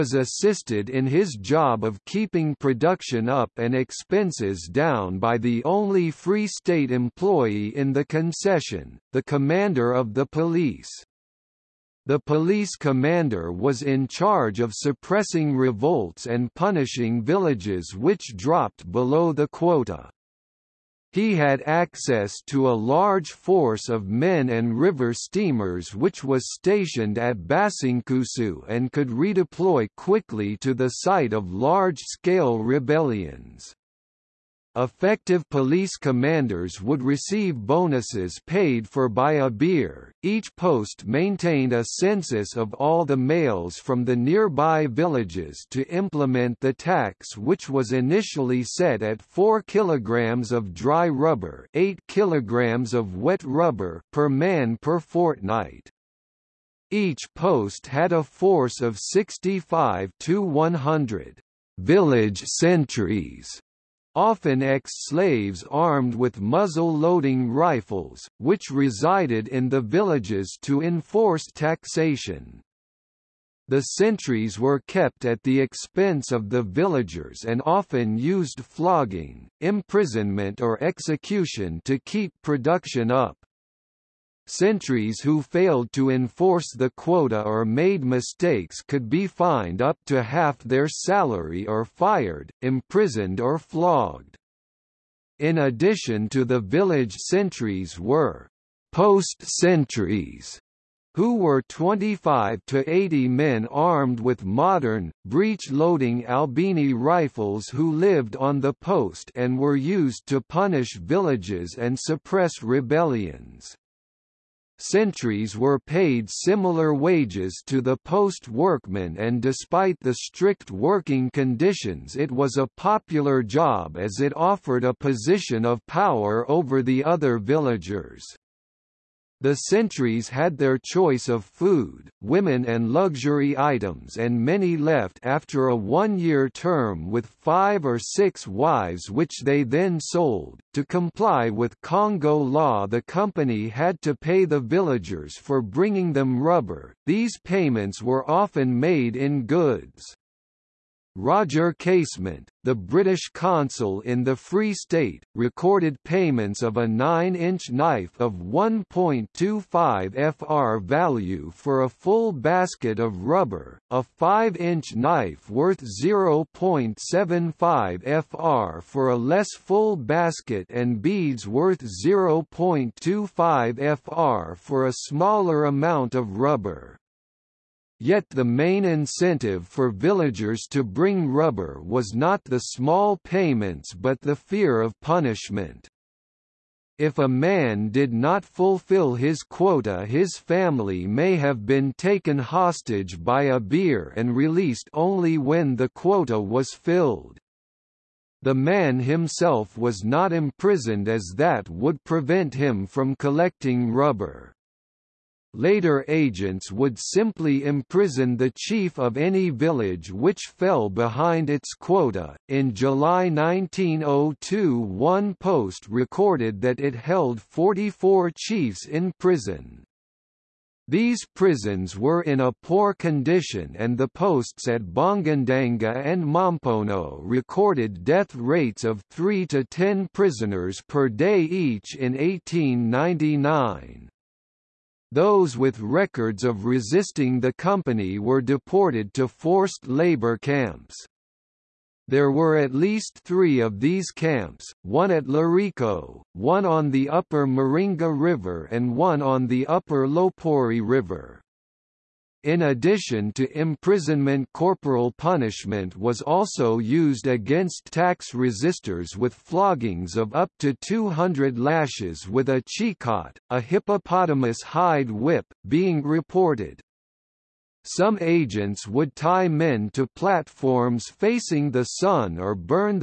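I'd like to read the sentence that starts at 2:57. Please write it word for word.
Yet the main incentive for villagers to bring rubber was not the small payments but the fear of punishment.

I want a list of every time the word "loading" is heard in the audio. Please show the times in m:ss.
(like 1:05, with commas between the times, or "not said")
1:06, 1:45.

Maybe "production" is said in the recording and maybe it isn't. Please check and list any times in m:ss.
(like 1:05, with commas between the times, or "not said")
0:02, 1:22.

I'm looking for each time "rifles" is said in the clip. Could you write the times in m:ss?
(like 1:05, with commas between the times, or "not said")
1:07, 1:46.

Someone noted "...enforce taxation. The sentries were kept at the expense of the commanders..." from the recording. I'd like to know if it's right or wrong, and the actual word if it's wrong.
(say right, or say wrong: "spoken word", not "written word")
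wrong: "villagers", not "commanders".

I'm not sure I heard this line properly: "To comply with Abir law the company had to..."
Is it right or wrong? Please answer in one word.
wrong.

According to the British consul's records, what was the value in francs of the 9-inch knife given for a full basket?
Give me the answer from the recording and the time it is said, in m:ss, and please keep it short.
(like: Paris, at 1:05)
1.25 FR, at 2:38.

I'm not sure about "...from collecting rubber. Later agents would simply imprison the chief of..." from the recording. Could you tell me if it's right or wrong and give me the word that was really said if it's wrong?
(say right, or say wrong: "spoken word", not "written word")
right.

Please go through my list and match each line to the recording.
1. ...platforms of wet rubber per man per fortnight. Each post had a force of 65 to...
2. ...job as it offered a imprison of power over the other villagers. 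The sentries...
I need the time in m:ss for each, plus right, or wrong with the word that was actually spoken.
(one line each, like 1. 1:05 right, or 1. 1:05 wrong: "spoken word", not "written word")
1. 0:52 wrong: "kilograms", not "platforms"
2. 2:03 wrong: "position", not "imprison".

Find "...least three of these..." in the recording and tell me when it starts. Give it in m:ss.
4:02.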